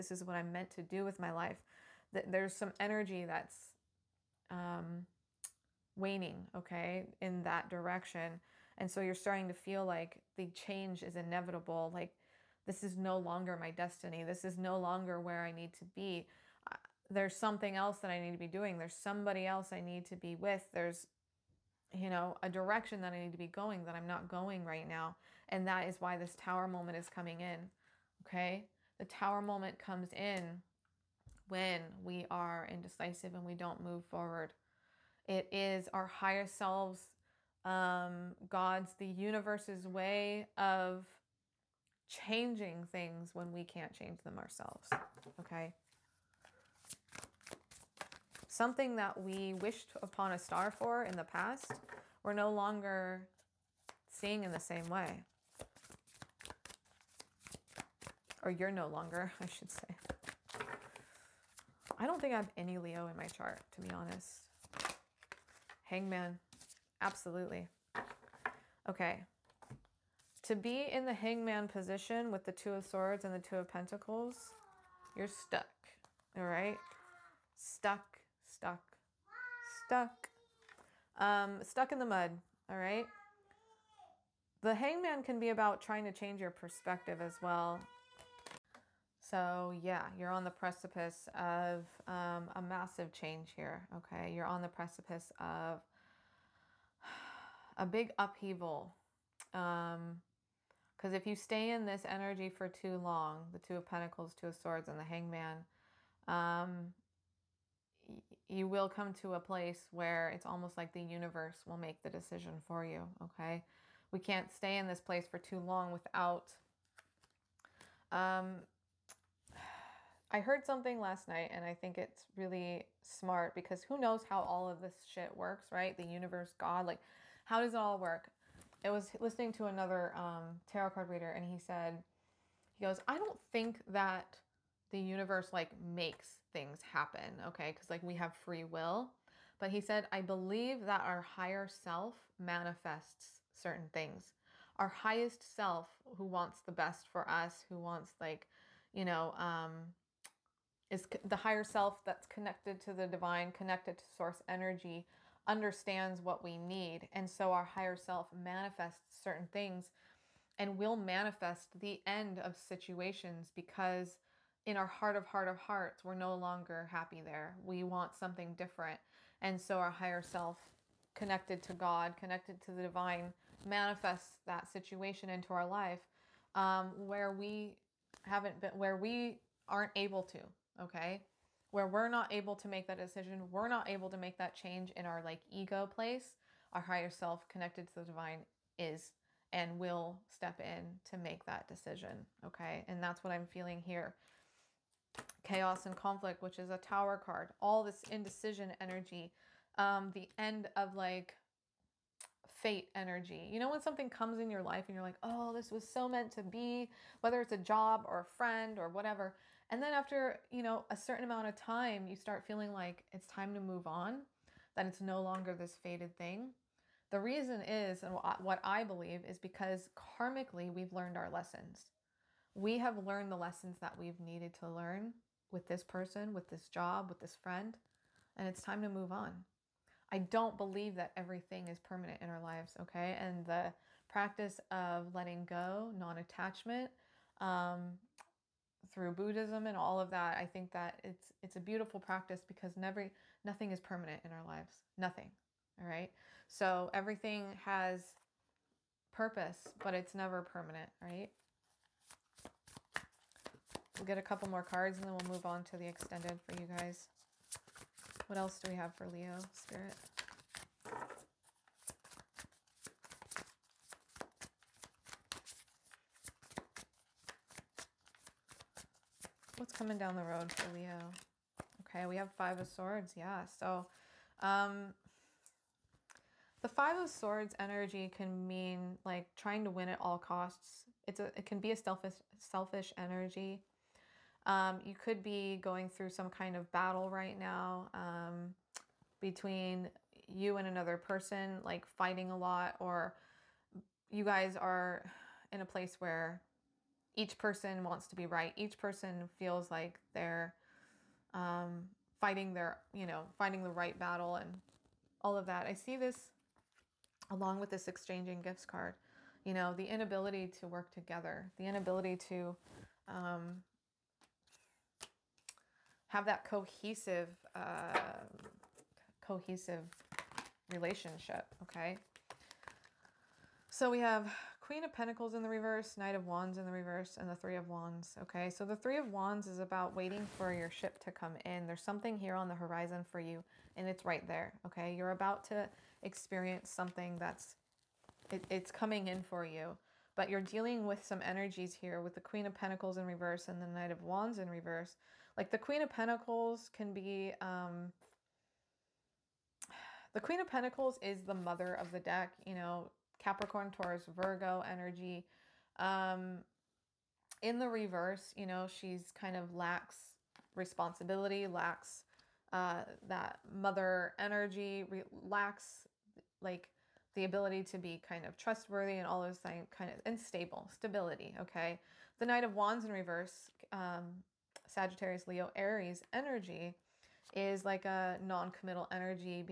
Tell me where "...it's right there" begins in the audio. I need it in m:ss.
5:33.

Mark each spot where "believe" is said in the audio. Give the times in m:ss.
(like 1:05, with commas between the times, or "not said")
2:20, 3:38, 3:50.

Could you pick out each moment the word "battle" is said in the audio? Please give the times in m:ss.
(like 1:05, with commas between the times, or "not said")
4:46, 5:03.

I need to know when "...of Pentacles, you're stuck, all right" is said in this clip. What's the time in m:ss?
1:13.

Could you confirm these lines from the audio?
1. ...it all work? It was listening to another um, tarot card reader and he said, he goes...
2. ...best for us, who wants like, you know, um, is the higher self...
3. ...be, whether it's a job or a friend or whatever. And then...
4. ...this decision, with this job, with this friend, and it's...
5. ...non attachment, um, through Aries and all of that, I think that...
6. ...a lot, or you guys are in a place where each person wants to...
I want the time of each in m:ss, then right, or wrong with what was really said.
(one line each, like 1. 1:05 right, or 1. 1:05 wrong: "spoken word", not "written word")
1. 2:07 right
2. 2:26 right
3. 3:26 right
4. 3:45 wrong: "person", not "decision"
5. 3:55 wrong: "Buddhism", not "Aries"
6. 4:52 right.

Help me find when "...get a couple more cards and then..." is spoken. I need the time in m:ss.
4:14.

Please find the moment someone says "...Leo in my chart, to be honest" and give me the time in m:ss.
1:02.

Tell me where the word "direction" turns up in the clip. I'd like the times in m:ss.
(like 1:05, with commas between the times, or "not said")
0:07, 0:22.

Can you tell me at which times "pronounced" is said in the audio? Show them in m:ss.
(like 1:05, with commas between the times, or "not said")
not said.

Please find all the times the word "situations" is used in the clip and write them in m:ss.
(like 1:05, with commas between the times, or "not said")
2:42, 2:54.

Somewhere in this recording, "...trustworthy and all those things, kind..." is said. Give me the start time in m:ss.
6:08.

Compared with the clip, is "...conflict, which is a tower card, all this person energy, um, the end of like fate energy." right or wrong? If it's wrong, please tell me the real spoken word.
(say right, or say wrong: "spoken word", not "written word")
wrong: "indecision", not "person".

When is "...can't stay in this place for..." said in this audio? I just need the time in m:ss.
1:54.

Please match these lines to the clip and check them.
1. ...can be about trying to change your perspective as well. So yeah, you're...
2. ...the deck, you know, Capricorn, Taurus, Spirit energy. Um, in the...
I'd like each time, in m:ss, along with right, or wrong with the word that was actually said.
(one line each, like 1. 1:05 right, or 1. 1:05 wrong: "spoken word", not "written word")
1. 1:25 right
2. 5:51 wrong: "Virgo", not "Spirit".